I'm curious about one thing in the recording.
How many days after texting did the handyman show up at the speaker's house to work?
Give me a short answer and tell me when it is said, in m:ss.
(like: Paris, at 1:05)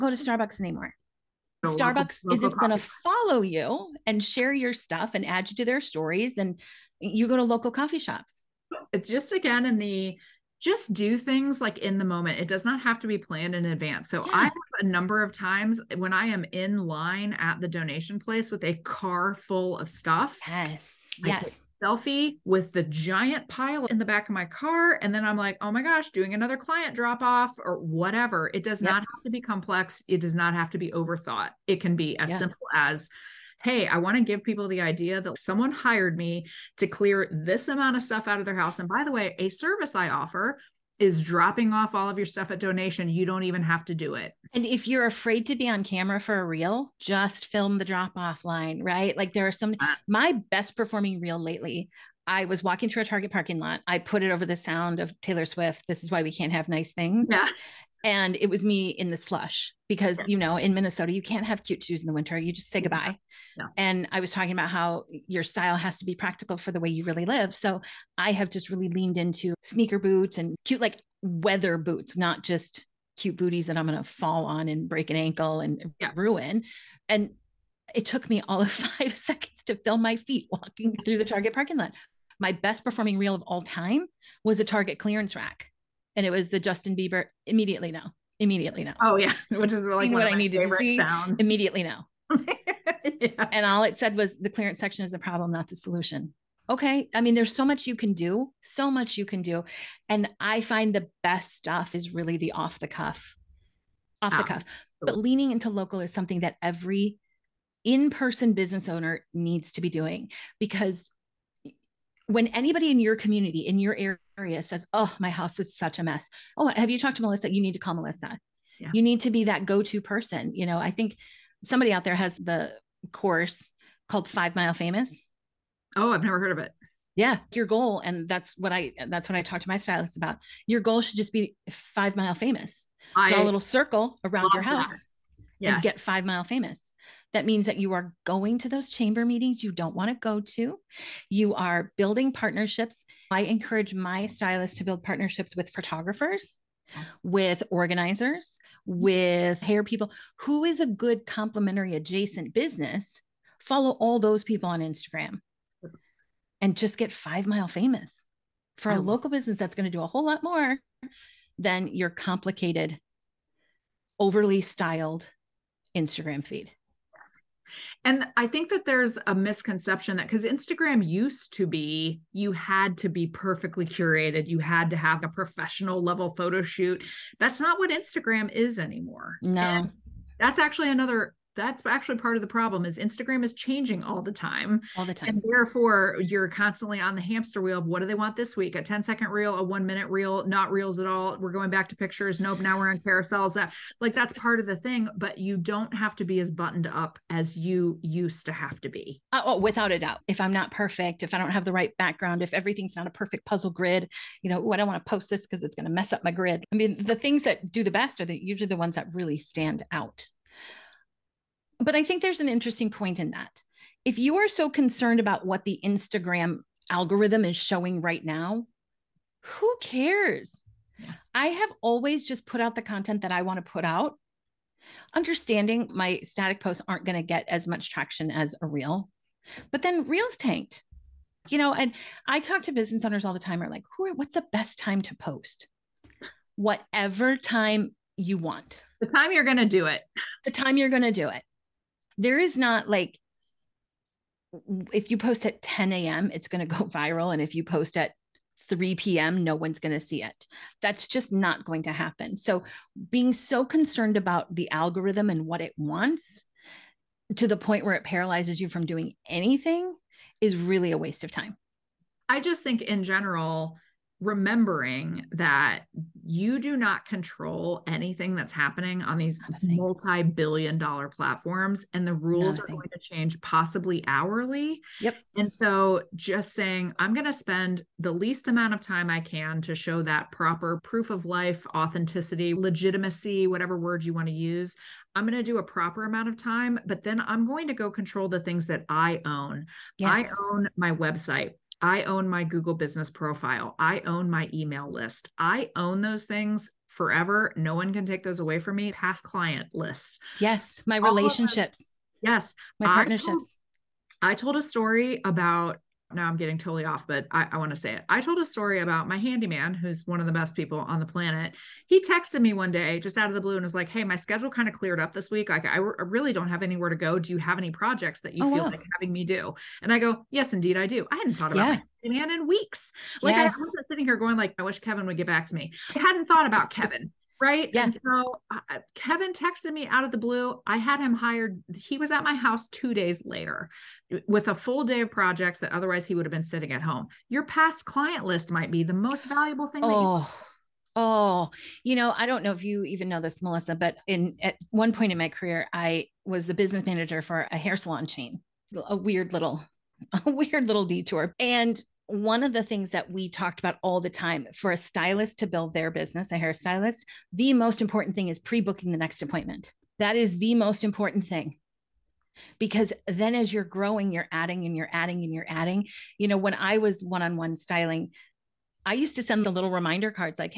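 2, at 5:32.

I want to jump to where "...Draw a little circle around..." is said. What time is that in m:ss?
2:13.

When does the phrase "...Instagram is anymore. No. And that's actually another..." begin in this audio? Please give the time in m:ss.
2:57.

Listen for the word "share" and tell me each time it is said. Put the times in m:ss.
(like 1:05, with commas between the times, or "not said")
0:04.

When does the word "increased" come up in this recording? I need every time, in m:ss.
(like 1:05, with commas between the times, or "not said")
not said.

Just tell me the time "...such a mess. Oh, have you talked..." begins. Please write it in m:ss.
1:55.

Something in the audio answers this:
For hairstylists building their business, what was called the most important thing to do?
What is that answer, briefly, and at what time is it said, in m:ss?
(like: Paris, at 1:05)
Pre booking the next appointment, at 5:58.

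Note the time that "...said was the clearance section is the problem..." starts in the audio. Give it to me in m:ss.
1:33.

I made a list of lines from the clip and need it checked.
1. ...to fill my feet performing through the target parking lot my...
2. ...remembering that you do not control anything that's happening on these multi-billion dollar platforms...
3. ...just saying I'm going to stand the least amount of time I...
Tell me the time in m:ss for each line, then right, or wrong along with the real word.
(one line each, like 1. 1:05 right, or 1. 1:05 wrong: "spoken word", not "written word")
1. 1:19 wrong: "walking", not "performing"
2. 4:24 right
3. 4:36 wrong: "spend", not "stand".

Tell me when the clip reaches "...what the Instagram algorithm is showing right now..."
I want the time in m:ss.
3:35.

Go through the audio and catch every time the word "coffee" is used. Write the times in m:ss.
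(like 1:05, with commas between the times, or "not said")
0:07.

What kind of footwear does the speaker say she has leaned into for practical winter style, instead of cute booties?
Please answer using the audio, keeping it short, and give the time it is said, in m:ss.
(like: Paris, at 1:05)
Sneaker boots, at 1:09.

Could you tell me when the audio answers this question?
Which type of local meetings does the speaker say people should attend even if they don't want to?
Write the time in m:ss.
2:18.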